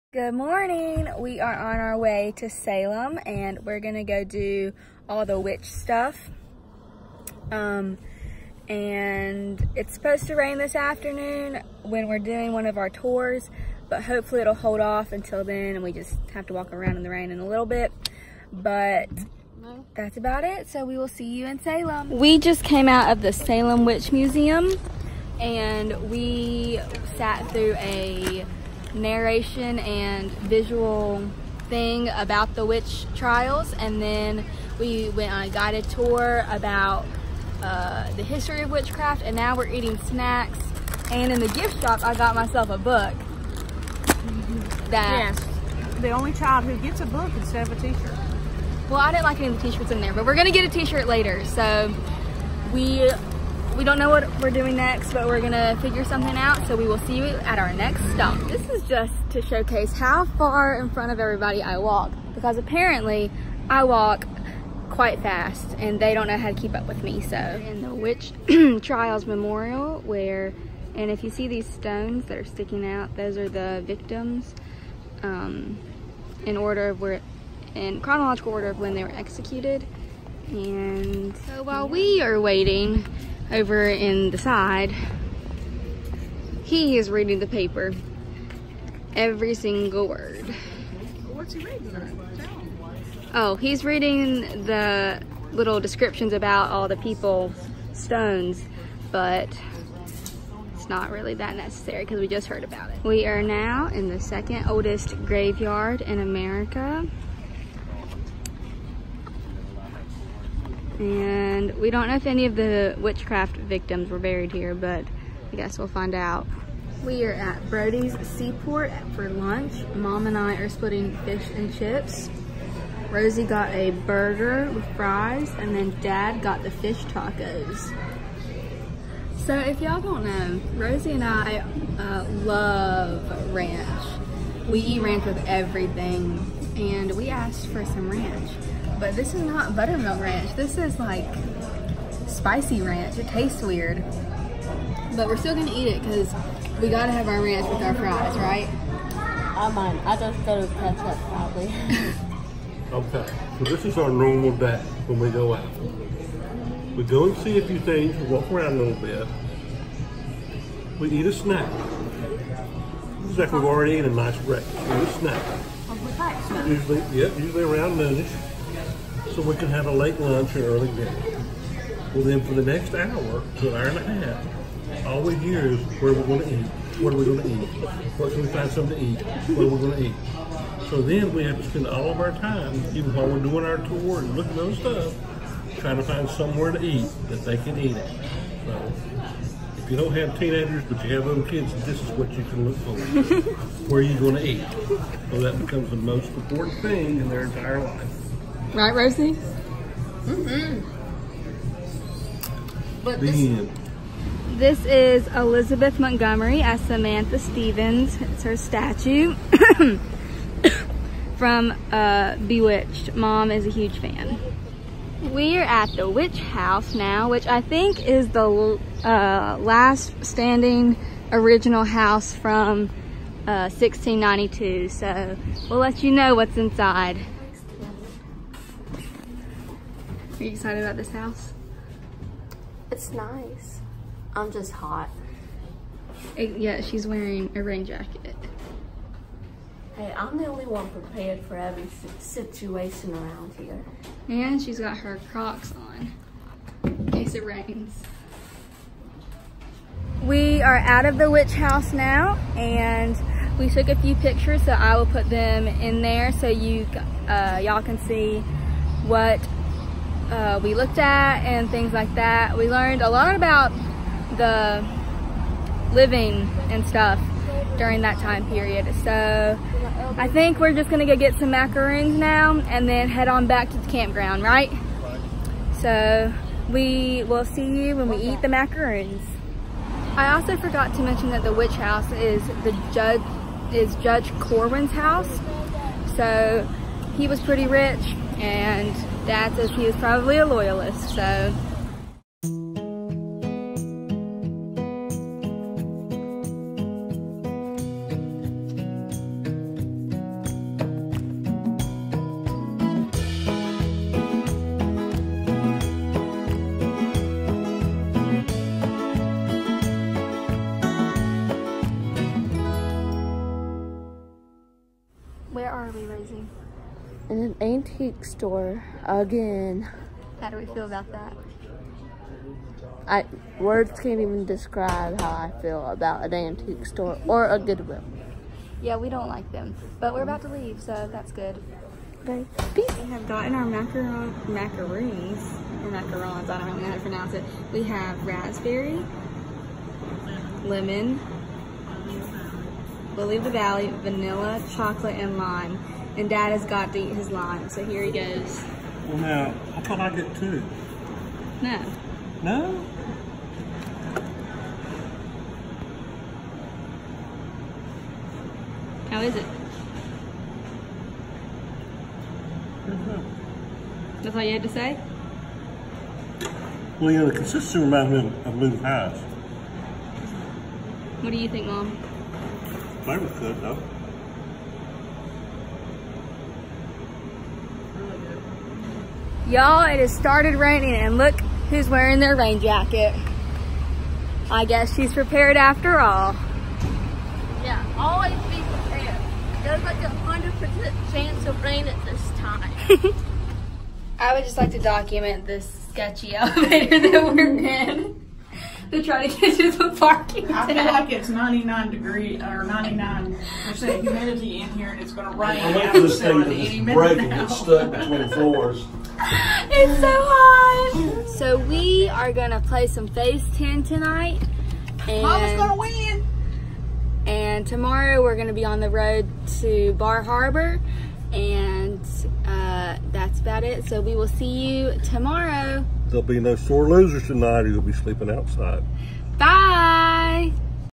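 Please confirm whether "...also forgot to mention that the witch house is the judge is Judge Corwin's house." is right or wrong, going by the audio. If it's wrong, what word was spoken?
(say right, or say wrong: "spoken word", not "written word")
right.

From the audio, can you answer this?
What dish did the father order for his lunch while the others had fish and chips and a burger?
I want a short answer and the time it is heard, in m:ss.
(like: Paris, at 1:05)
Fish tacos, at 2:06.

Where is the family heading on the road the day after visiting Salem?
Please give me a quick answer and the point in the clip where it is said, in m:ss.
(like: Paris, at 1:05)
Bar Harbor, at 6:59.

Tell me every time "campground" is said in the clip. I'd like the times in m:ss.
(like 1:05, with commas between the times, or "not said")
4:33.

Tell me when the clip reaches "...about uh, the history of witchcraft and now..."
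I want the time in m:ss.
0:36.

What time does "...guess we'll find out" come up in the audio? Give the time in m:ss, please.
1:55.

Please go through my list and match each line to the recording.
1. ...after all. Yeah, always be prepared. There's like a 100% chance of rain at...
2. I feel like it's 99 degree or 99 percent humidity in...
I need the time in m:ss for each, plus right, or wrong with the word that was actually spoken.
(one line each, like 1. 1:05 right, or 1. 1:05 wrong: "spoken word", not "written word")
1. 6:25 right
2. 6:40 right.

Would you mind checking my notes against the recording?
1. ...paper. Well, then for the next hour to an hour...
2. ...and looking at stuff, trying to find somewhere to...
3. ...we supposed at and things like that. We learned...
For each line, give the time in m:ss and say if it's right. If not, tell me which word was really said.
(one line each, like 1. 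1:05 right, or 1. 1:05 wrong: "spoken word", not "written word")
1. 2:50 wrong: "dinner", not "paper"
2. 3:04 right
3. 4:20 wrong: "looked", not "supposed".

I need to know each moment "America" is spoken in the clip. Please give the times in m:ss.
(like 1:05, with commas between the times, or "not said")
1:46.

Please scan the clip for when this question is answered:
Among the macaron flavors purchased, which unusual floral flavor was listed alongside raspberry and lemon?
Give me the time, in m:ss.
5:43.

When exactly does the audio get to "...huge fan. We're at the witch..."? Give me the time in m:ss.
3:33.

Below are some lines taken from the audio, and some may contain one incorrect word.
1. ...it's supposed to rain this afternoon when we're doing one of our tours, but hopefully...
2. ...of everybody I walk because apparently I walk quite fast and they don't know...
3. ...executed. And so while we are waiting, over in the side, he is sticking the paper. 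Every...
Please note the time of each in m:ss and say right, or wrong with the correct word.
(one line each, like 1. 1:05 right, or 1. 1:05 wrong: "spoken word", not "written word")
1. 0:09 right
2. 1:01 right
3. 1:19 wrong: "reading", not "sticking".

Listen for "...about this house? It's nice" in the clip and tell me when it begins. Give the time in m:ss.
3:50.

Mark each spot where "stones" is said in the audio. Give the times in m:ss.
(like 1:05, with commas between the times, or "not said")
1:11, 1:37.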